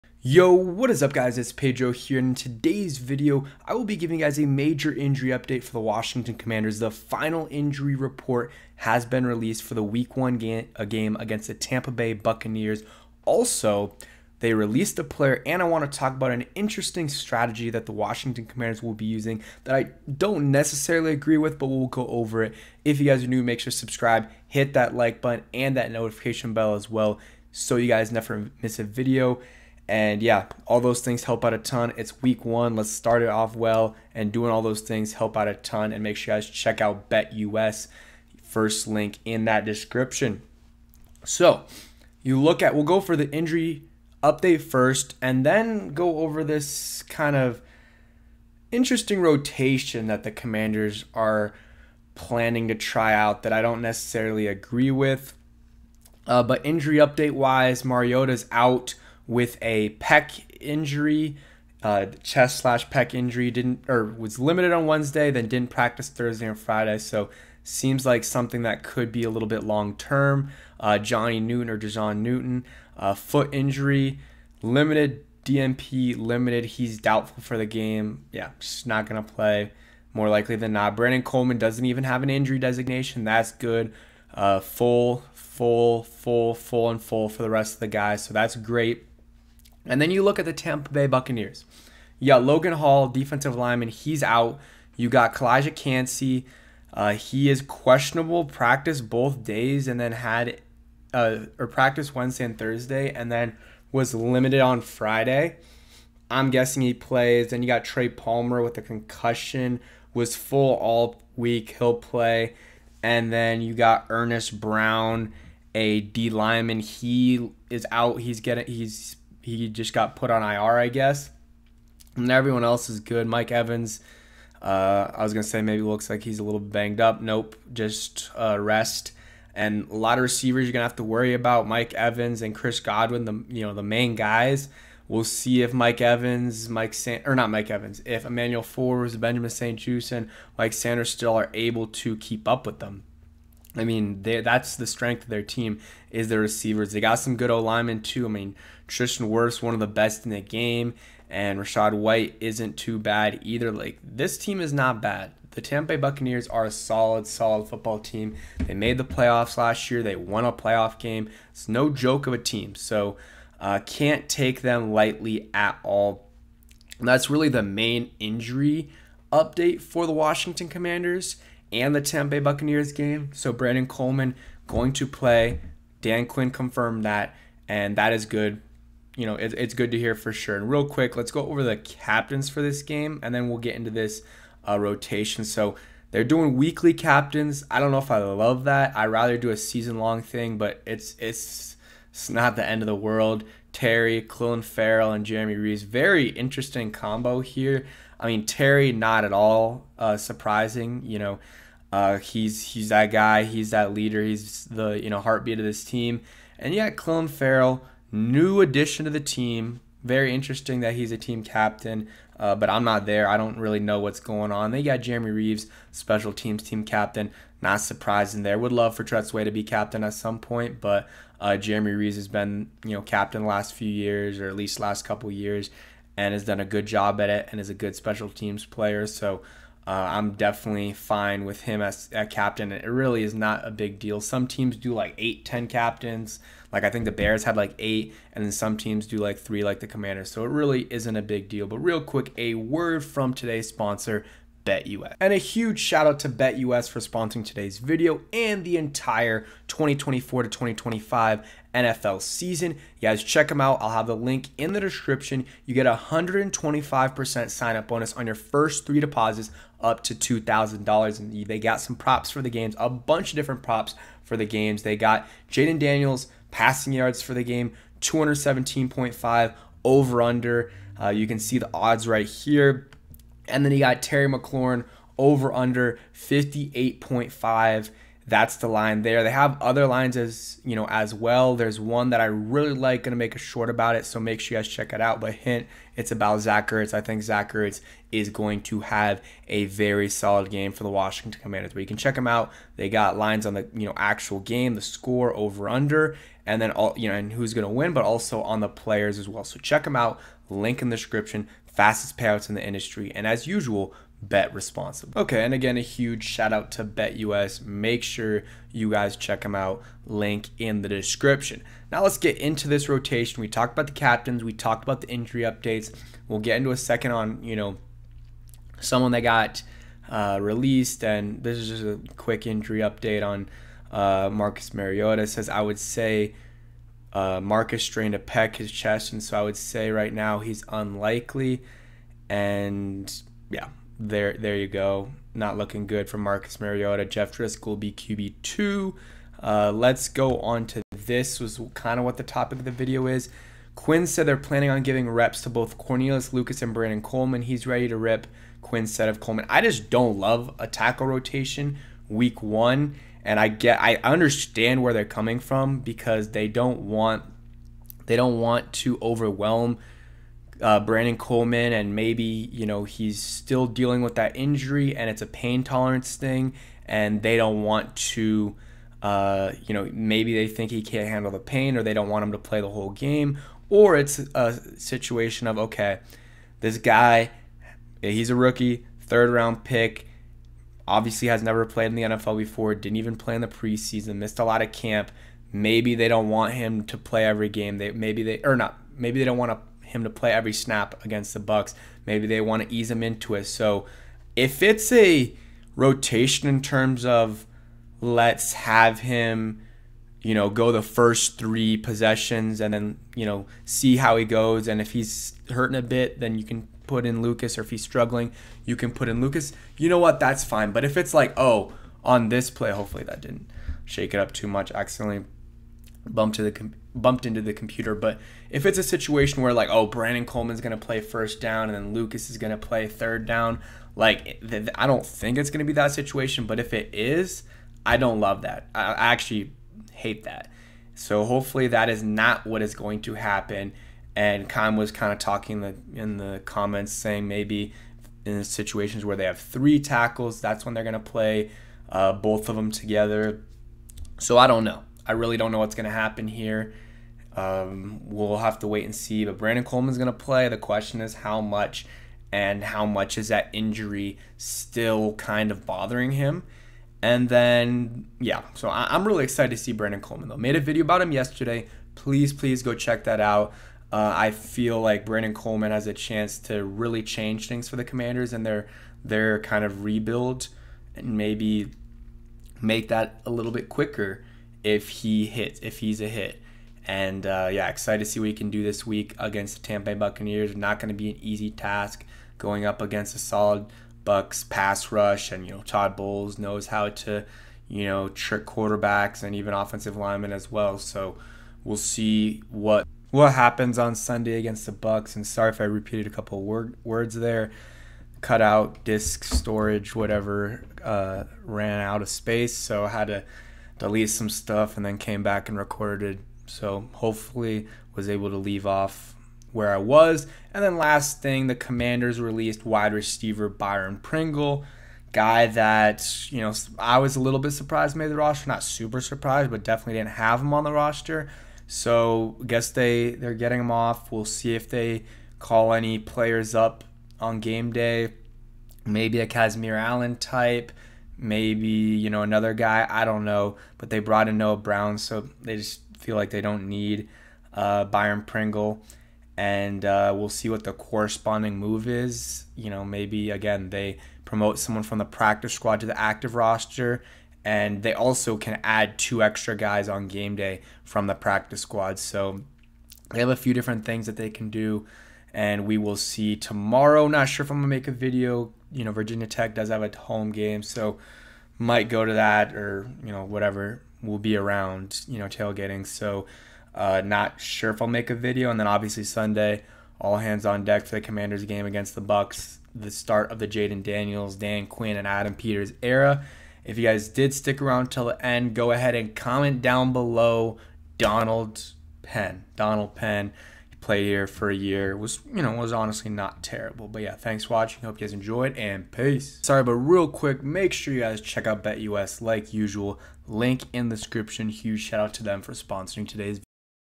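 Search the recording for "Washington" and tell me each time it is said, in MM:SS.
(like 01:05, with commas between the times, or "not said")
00:05, 00:17, 02:50, 04:50.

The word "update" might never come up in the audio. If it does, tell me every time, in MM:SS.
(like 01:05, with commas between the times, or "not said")
00:05, 00:44, 00:56, 02:49, 05:15, 05:22.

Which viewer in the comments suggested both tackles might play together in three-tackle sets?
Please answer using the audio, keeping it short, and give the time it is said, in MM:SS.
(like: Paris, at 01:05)
Khan, at 07:14.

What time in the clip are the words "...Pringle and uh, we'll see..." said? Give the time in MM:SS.
08:58.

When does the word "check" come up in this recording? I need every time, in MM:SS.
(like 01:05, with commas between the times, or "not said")
00:36, 04:13, 04:44, 04:51, 04:59, 05:09, 07:42, 09:51.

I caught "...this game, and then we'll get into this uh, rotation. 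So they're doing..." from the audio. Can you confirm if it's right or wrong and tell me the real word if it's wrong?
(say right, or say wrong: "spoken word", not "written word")
right.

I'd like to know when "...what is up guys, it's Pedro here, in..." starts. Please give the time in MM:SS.
00:00.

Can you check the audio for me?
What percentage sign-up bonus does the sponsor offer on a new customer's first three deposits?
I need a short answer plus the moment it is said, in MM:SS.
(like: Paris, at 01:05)
125%, at 04:16.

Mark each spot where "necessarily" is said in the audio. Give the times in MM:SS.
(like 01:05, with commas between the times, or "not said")
00:20, 00:53.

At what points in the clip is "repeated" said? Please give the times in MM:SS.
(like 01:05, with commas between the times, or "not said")
08:15.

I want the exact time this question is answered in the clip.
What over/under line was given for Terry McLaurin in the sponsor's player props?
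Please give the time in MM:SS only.
04:36.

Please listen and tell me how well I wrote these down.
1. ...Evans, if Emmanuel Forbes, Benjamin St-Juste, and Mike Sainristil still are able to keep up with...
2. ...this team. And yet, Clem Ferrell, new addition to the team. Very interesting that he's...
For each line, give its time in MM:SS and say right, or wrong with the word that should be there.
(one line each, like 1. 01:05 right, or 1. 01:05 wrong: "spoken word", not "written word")
1. 02:17 right
2. 03:25 right.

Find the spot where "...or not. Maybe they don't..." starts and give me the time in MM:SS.
06:28.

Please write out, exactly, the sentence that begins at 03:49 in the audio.
So uh, I'm definitely fine with him as a captain.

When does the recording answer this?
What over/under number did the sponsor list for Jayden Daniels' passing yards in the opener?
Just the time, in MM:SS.
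04:28.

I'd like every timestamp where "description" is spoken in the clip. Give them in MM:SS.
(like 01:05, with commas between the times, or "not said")
00:39, 04:14, 05:00, 05:10, 09:53.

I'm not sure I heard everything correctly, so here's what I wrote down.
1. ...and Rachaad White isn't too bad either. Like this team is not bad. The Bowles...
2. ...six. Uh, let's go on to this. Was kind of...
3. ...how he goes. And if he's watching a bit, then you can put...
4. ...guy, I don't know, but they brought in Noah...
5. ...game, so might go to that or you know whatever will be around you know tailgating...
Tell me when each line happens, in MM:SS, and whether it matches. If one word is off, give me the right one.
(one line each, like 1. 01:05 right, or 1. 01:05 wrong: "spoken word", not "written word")
1. 02:31 wrong: "Tampa", not "Bowles"
2. 05:38 wrong: "two", not "six"
3. 06:43 wrong: "hurting", not "watching"
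4. 08:52 right
5. 09:20 right.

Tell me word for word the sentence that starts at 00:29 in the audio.
And yeah, all those things help out a ton.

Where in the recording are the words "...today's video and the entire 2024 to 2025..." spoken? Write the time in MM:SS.
04:07.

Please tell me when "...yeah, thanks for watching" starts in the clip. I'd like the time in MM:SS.
09:47.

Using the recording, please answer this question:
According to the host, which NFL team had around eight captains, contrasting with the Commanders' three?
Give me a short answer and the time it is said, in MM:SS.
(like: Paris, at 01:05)
Bears, at 03:57.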